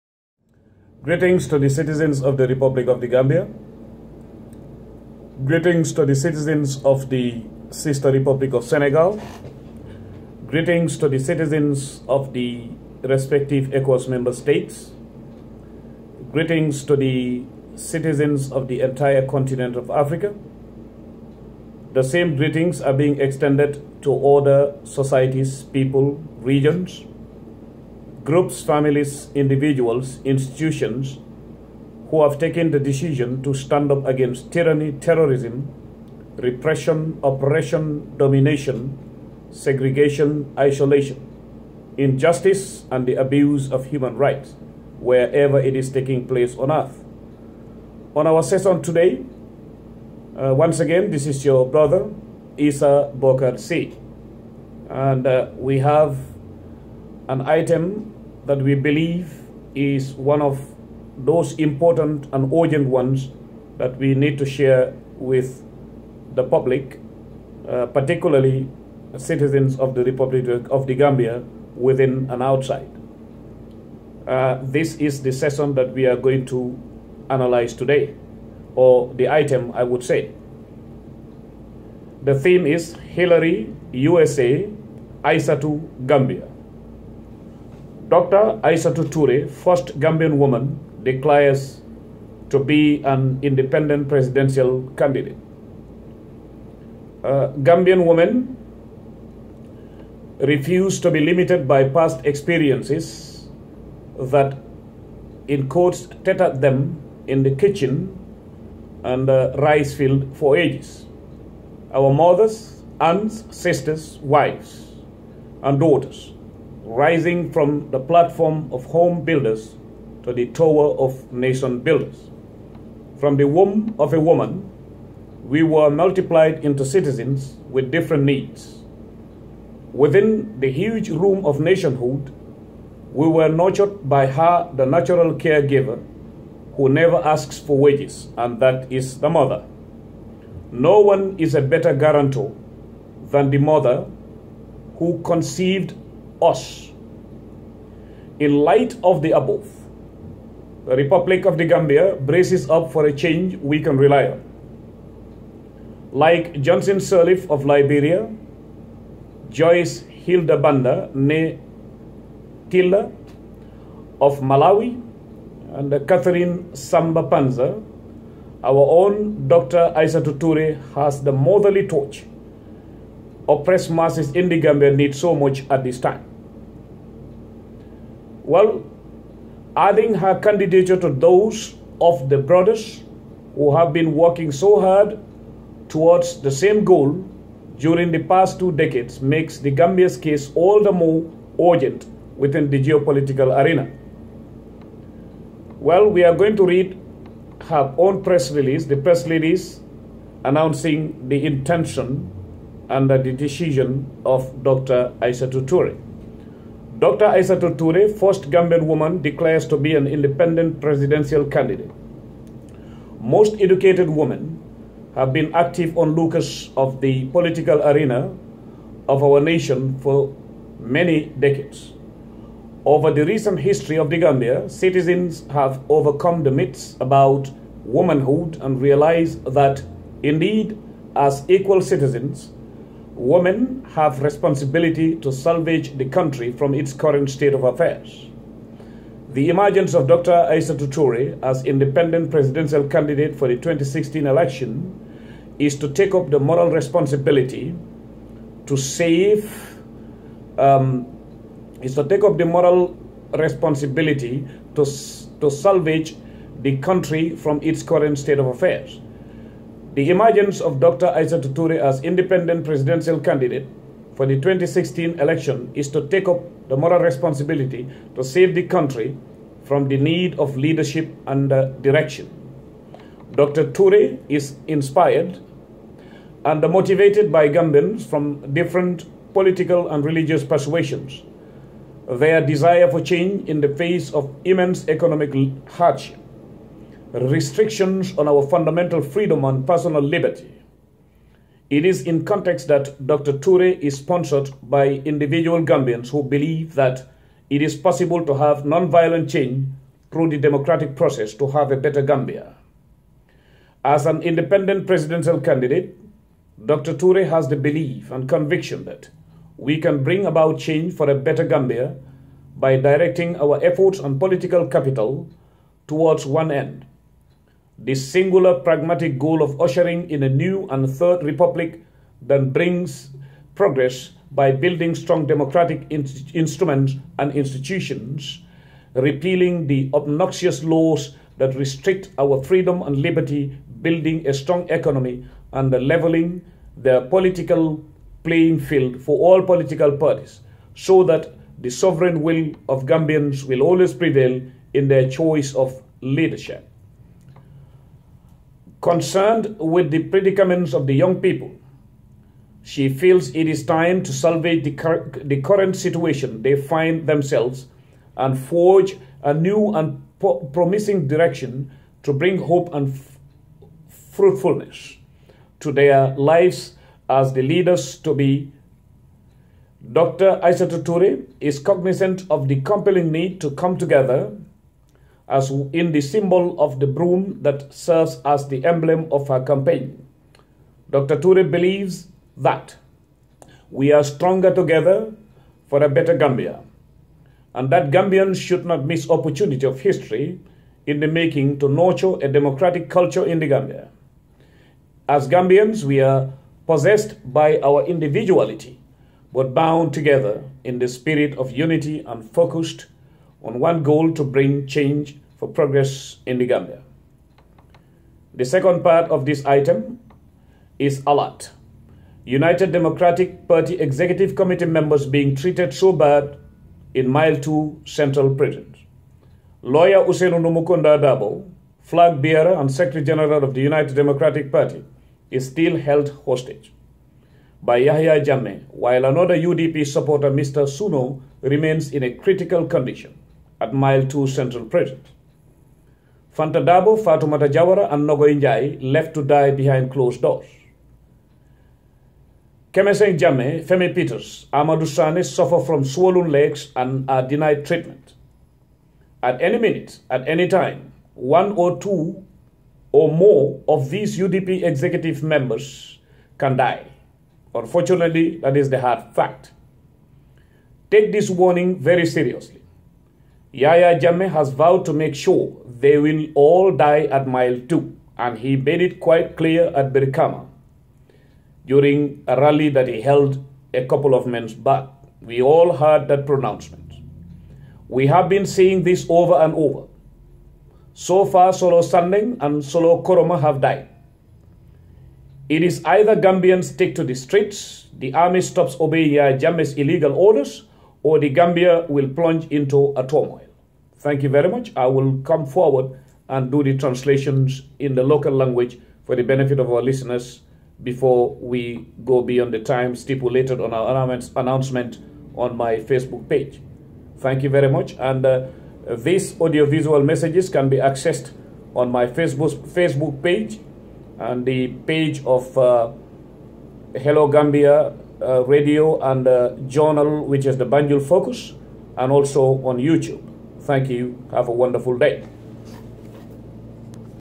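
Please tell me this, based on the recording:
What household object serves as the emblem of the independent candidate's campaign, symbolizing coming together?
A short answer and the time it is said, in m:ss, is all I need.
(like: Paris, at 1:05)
The broom, at 6:16.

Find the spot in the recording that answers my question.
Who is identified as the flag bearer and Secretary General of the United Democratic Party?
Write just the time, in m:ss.
7:00.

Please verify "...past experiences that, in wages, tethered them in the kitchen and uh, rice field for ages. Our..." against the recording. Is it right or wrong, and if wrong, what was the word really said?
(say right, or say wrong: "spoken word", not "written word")
wrong: "quotes", not "wages".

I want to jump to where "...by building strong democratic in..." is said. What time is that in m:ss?
5:24.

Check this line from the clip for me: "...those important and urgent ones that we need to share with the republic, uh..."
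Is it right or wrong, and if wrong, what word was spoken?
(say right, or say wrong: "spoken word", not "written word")
wrong: "public", not "republic".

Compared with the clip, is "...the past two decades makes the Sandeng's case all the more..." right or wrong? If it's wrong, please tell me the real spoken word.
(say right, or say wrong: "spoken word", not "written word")
wrong: "Gambia", not "Sandeng".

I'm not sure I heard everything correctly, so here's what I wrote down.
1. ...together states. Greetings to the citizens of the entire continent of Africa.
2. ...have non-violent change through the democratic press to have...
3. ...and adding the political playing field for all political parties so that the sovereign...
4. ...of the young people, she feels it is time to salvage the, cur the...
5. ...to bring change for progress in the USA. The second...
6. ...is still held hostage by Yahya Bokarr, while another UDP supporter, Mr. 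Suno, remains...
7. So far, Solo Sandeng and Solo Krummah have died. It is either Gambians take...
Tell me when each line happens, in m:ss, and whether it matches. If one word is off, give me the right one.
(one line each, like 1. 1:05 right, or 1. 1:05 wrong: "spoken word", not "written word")
1. 0:14 wrong: "member", not "together"
2. 4:58 wrong: "process", not "press"
3. 5:35 wrong: "leveling", not "adding"
4. 5:50 right
5. 6:44 wrong: "Gambia", not "USA"
6. 7:05 wrong: "Jammeh", not "Bokarr"
7. 8:00 right.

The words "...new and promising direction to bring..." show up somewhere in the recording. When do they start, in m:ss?
5:59.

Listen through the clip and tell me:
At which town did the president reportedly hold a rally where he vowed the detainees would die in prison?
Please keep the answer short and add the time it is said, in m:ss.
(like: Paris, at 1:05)
Brikama, at 7:49.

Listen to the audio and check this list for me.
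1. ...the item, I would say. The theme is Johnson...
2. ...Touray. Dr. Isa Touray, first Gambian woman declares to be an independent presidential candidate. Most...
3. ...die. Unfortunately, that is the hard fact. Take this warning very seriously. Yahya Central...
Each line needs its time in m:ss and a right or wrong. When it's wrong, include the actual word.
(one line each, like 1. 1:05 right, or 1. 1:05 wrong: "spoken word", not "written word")
1. 1:19 wrong: "Hillary", not "Johnson"
2. 3:25 right
3. 7:36 wrong: "Jammeh", not "Central".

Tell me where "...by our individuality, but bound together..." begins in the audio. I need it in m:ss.
6:37.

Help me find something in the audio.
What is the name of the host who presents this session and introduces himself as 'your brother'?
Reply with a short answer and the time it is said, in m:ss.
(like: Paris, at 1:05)
Essa Bokarr Sey, at 0:52.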